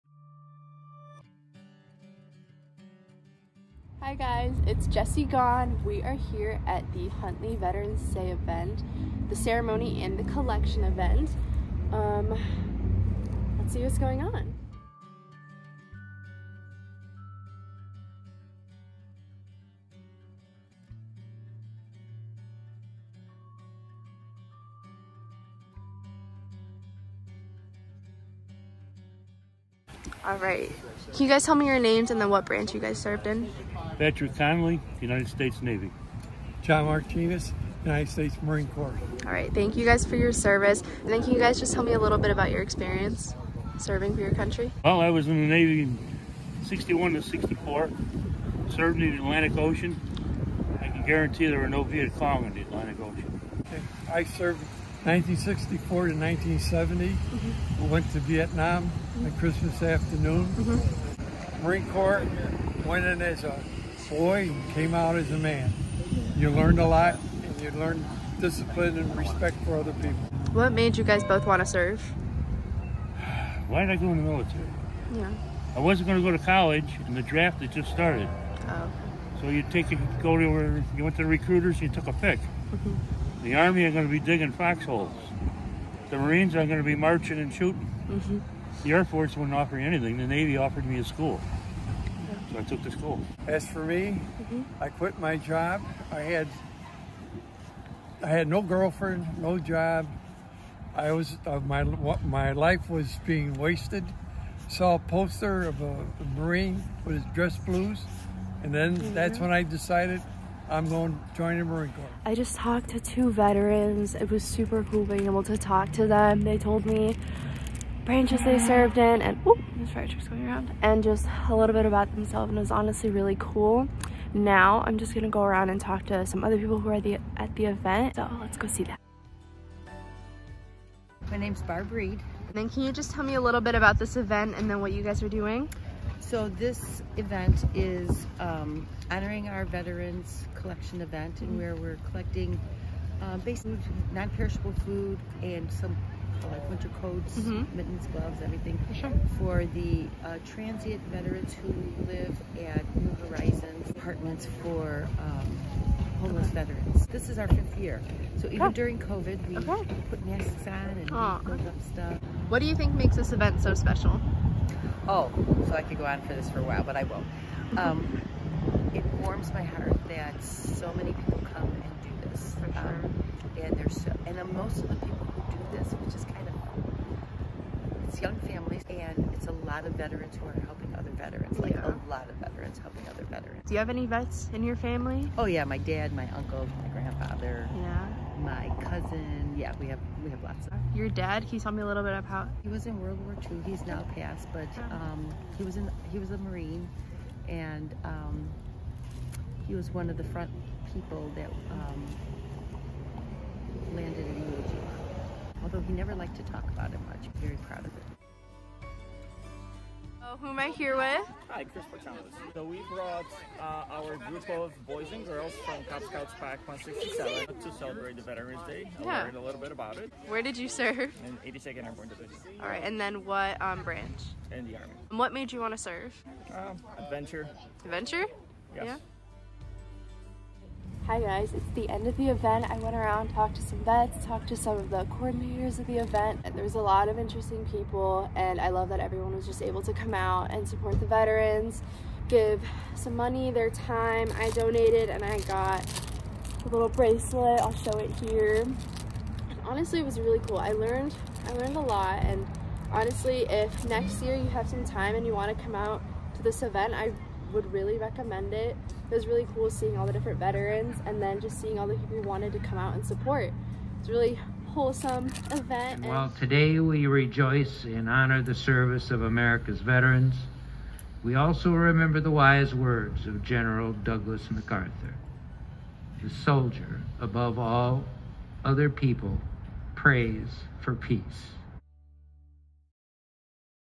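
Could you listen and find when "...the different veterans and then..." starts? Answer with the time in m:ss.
4:20.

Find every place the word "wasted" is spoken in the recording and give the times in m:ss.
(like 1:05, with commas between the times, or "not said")
1:43.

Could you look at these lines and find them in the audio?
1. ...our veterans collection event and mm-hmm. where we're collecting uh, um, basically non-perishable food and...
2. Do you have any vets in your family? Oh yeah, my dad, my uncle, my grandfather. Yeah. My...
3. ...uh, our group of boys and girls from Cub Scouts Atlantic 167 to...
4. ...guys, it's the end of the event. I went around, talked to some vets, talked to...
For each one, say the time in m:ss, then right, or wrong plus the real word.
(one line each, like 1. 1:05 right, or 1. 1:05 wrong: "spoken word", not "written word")
1. 2:19 right
2. 3:03 right
3. 3:33 wrong: "Pack", not "Atlantic"
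4. 3:51 right.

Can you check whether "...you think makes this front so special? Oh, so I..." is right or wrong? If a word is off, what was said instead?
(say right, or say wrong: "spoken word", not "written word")
wrong: "event", not "front".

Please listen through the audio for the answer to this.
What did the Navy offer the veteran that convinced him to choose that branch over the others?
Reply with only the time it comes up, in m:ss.
1:30.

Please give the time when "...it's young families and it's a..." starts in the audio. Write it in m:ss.
2:58.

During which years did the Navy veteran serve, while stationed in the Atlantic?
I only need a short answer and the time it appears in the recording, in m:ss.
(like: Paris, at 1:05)
1961 to 1964, at 0:46.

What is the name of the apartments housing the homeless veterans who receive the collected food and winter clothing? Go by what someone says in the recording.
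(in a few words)
New Horizons.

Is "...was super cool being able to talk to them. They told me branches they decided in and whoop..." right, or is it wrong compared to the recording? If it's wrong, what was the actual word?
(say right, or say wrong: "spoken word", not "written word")
wrong: "served", not "decided".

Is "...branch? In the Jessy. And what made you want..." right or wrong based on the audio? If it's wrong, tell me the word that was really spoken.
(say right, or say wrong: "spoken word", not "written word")
wrong: "Army", not "Jessy".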